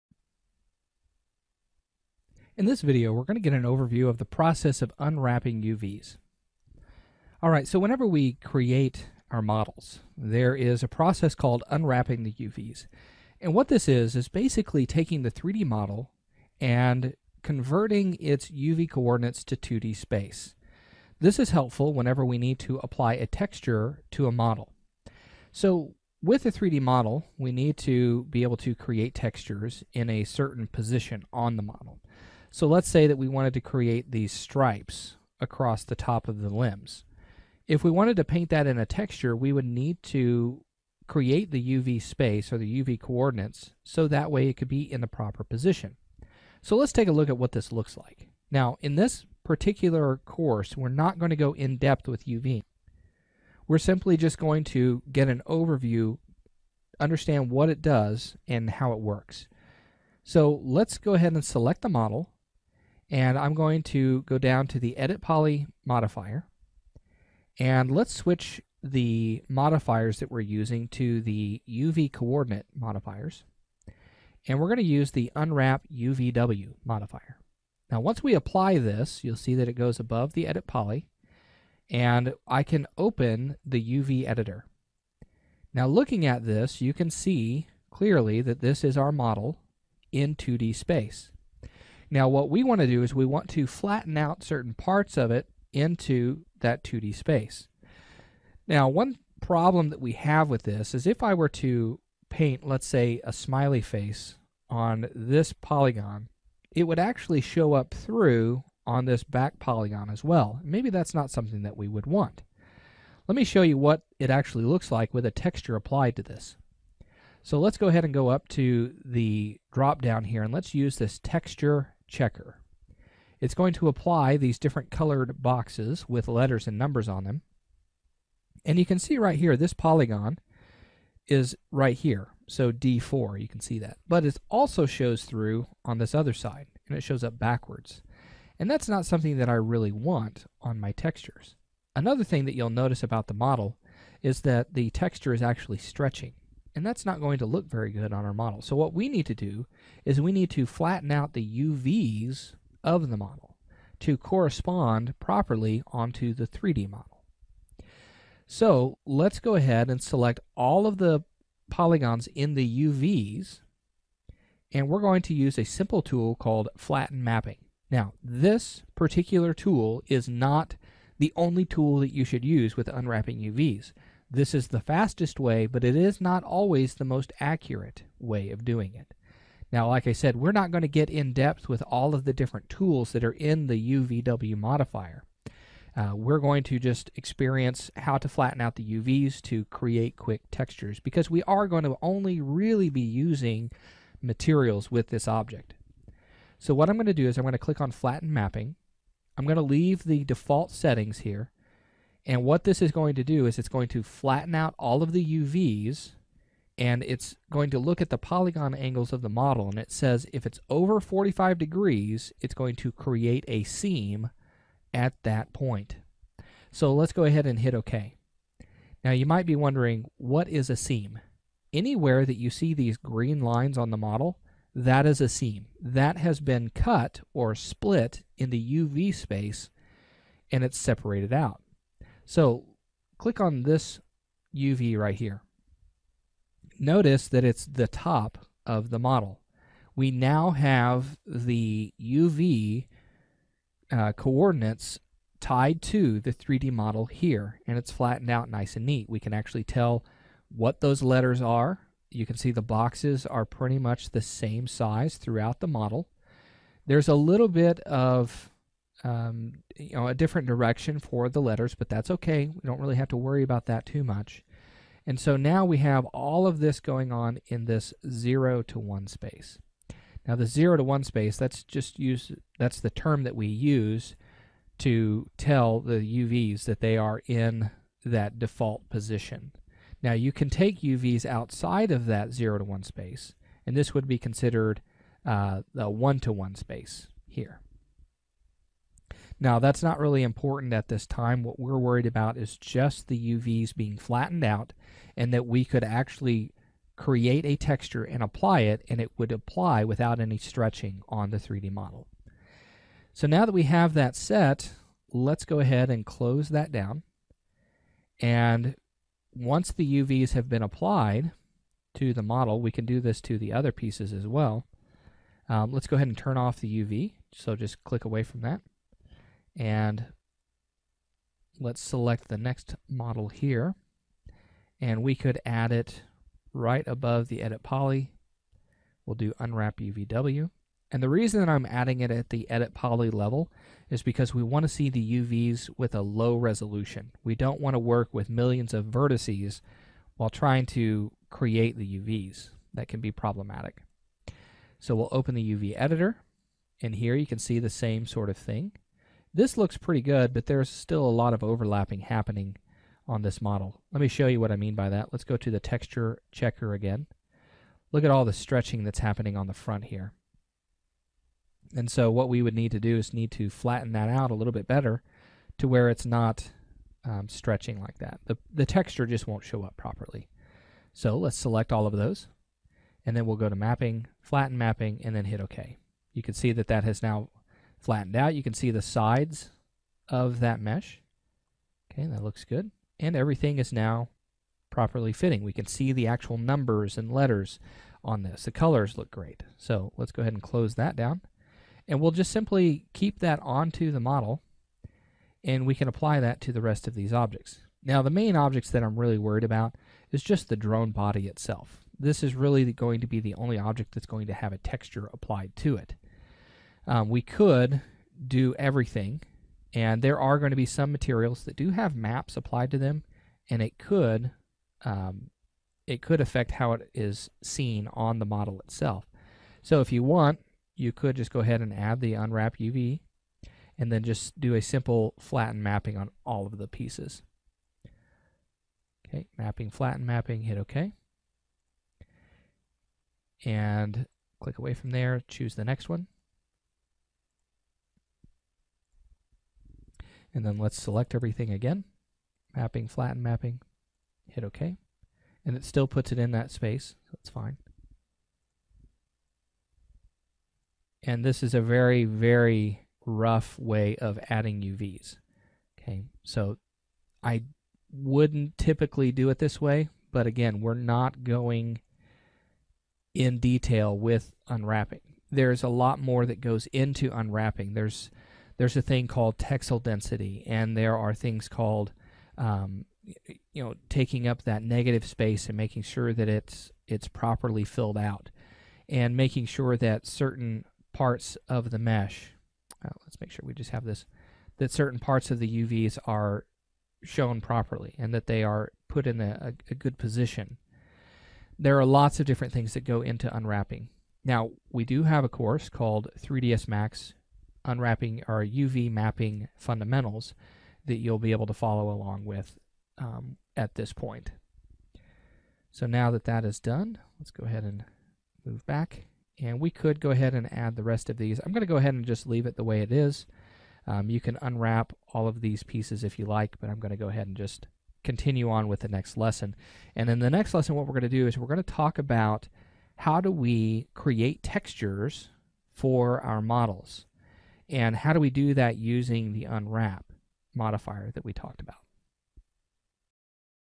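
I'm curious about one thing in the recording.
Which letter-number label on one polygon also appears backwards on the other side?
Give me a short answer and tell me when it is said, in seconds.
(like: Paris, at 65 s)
D4, at 132 s.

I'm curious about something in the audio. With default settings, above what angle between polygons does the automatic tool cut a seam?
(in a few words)
45 degrees.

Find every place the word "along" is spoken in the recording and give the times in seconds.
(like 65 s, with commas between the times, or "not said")
501 s.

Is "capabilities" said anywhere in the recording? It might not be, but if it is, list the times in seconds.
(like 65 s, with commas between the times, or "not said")
not said.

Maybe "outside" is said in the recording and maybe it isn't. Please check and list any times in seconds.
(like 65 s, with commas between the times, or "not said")
281 s.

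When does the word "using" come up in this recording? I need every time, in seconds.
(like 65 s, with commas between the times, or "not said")
70 s, 193 s, 528 s.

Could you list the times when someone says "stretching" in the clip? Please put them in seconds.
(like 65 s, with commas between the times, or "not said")
145 s, 300 s, 358 s, 367 s.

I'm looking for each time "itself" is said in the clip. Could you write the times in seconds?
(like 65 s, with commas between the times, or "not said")
401 s, 418 s.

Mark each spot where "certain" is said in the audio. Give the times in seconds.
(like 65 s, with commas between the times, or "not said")
30 s, 94 s, 480 s, 484 s.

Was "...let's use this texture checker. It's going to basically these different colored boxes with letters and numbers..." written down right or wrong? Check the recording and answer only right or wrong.
wrong.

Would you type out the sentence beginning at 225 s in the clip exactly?
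That has been cut or split in the UV space and it's separated out.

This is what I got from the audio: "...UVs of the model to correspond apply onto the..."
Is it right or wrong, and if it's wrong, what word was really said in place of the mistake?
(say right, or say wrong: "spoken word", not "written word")
wrong: "properly", not "apply".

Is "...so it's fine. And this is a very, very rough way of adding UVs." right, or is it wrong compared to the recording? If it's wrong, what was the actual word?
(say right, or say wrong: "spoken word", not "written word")
right.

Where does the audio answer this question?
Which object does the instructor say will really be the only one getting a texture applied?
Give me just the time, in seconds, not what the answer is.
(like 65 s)
400 s.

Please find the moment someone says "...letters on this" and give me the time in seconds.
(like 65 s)
387 s.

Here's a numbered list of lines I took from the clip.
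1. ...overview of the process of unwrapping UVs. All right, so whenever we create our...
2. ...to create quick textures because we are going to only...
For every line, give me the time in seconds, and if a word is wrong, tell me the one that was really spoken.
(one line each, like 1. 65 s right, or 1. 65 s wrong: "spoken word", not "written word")
1. 3 s right
2. 189 s right.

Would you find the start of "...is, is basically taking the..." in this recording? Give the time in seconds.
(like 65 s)
13 s.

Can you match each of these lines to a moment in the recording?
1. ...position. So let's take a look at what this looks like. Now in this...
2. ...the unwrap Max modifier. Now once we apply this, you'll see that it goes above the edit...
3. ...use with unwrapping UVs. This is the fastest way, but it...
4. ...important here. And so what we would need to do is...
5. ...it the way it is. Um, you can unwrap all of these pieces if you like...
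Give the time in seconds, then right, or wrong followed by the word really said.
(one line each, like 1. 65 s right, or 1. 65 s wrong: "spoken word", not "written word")
1. 45 s right
2. 75 s wrong: "UVW", not "Max"
3. 172 s right
4. 359 s wrong: "front", not "important"
5. 512 s right.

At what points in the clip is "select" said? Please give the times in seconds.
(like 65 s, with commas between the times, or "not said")
61 s, 160 s, 321 s, 371 s, 440 s.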